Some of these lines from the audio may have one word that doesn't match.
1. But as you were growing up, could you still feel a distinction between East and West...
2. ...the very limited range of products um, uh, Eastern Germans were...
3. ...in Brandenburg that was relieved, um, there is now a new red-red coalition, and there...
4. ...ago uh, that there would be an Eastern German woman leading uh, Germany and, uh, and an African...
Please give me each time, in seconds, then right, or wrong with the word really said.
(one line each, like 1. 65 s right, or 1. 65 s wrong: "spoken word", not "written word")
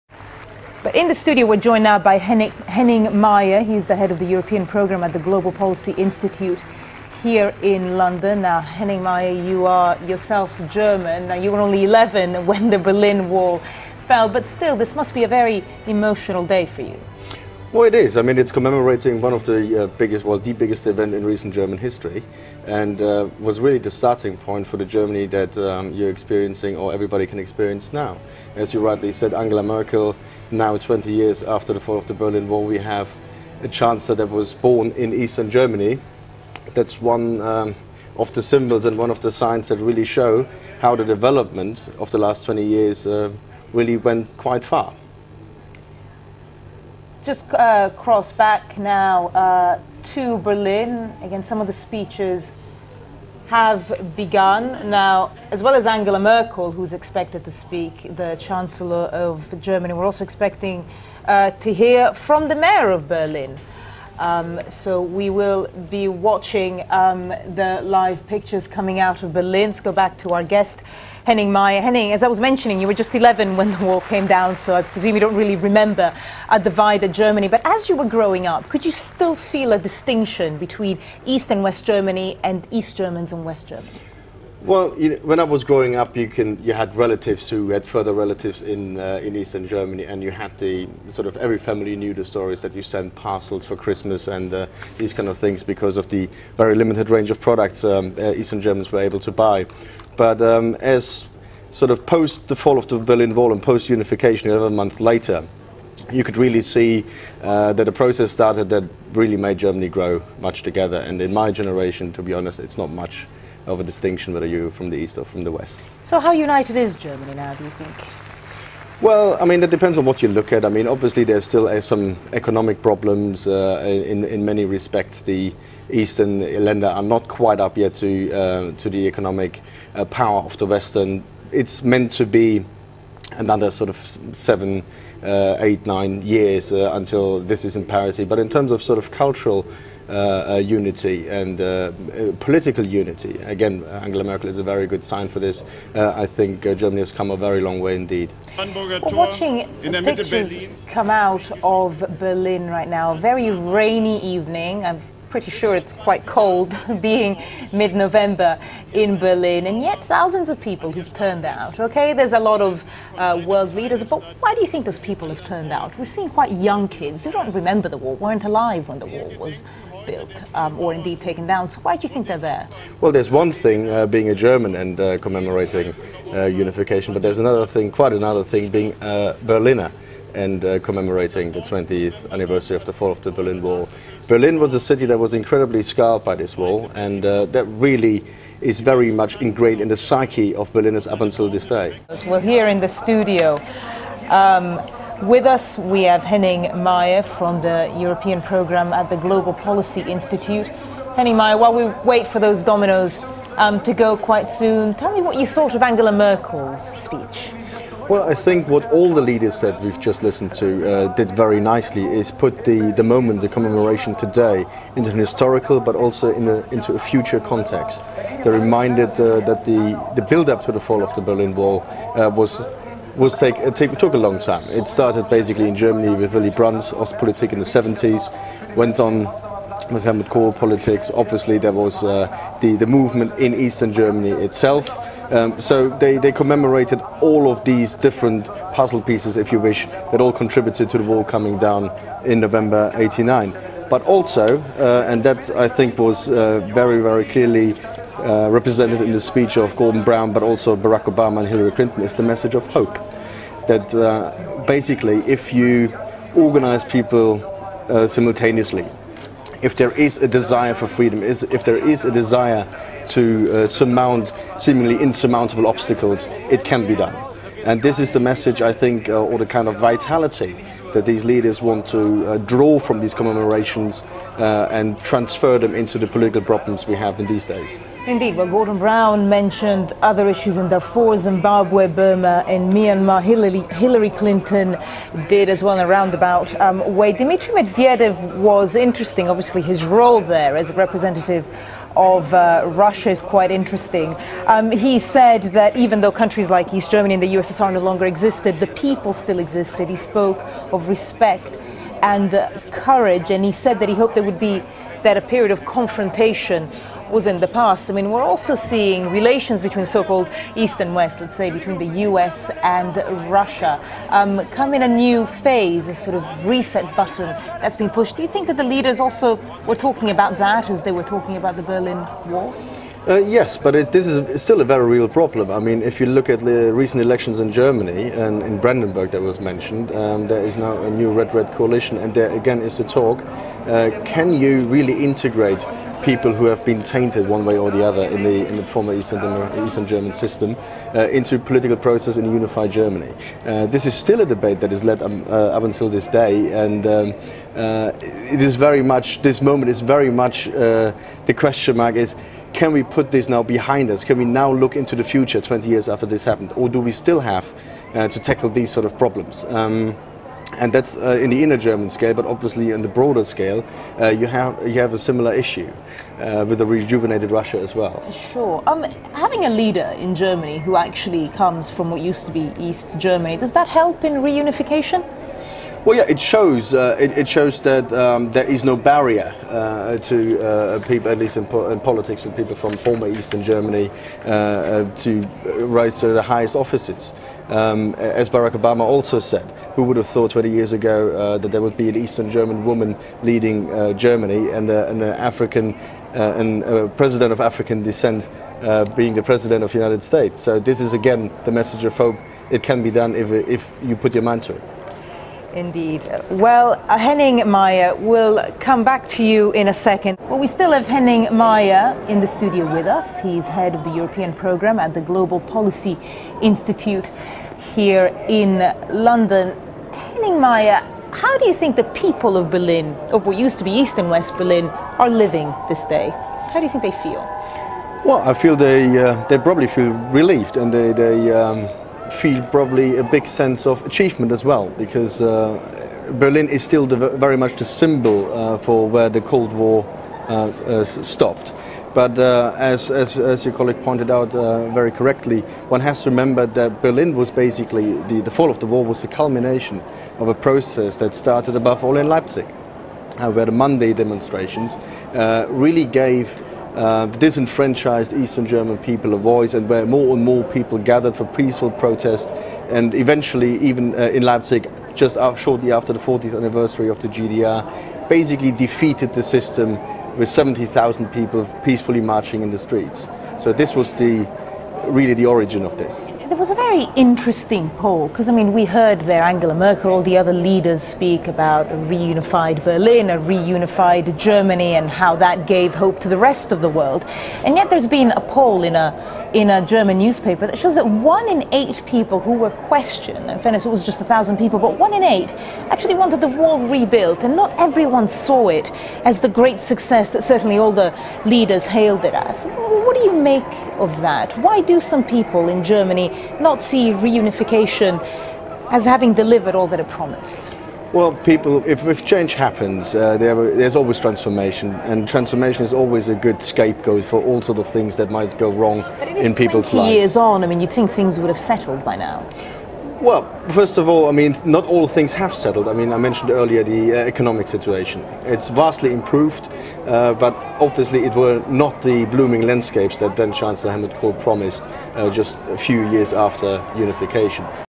1. 77 s right
2. 96 s right
3. 328 s wrong: "mentioned", not "relieved"
4. 390 s right.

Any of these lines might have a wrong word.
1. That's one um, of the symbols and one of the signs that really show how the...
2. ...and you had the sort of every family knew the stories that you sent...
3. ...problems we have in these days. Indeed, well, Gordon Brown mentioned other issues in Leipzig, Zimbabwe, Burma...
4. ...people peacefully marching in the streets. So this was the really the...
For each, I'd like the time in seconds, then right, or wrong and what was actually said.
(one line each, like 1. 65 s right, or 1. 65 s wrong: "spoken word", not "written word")
1. 36 s right
2. 90 s right
3. 276 s wrong: "Darfur", not "Leipzig"
4. 471 s right.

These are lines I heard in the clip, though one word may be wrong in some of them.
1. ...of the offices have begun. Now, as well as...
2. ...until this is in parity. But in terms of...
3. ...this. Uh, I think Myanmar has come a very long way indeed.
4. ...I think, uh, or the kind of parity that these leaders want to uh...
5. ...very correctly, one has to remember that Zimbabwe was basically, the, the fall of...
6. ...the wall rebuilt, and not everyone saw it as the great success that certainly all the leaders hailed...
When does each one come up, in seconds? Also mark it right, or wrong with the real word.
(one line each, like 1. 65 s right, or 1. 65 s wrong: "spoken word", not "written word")
1. 51 s wrong: "speeches", not "offices"
2. 136 s right
3. 145 s wrong: "Germany", not "Myanmar"
4. 268 s wrong: "vitality", not "parity"
5. 444 s wrong: "Berlin", not "Zimbabwe"
6. 496 s right.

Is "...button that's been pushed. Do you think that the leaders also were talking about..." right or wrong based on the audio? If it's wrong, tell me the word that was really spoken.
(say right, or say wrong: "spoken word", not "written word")
right.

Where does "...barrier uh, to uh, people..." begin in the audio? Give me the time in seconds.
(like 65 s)
378 s.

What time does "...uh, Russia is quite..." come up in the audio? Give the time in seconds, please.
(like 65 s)
292 s.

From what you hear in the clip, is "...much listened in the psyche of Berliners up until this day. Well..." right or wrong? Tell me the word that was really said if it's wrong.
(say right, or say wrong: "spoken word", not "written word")
wrong: "ingrained", not "listened".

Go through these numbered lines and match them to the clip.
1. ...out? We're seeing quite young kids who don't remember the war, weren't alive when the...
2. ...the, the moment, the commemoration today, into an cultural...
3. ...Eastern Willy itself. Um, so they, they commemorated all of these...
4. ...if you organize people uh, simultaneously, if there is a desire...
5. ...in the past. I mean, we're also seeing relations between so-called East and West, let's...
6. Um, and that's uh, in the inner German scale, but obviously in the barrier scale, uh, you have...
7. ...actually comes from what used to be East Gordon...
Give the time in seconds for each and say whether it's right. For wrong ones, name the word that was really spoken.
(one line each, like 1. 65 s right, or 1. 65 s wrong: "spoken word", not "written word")
1. 165 s right
2. 212 s wrong: "historical", not "cultural"
3. 233 s wrong: "Germany", not "Willy"
4. 255 s right
5. 307 s right
6. 359 s wrong: "broader", not "barrier"
7. 370 s wrong: "Germany", not "Gordon".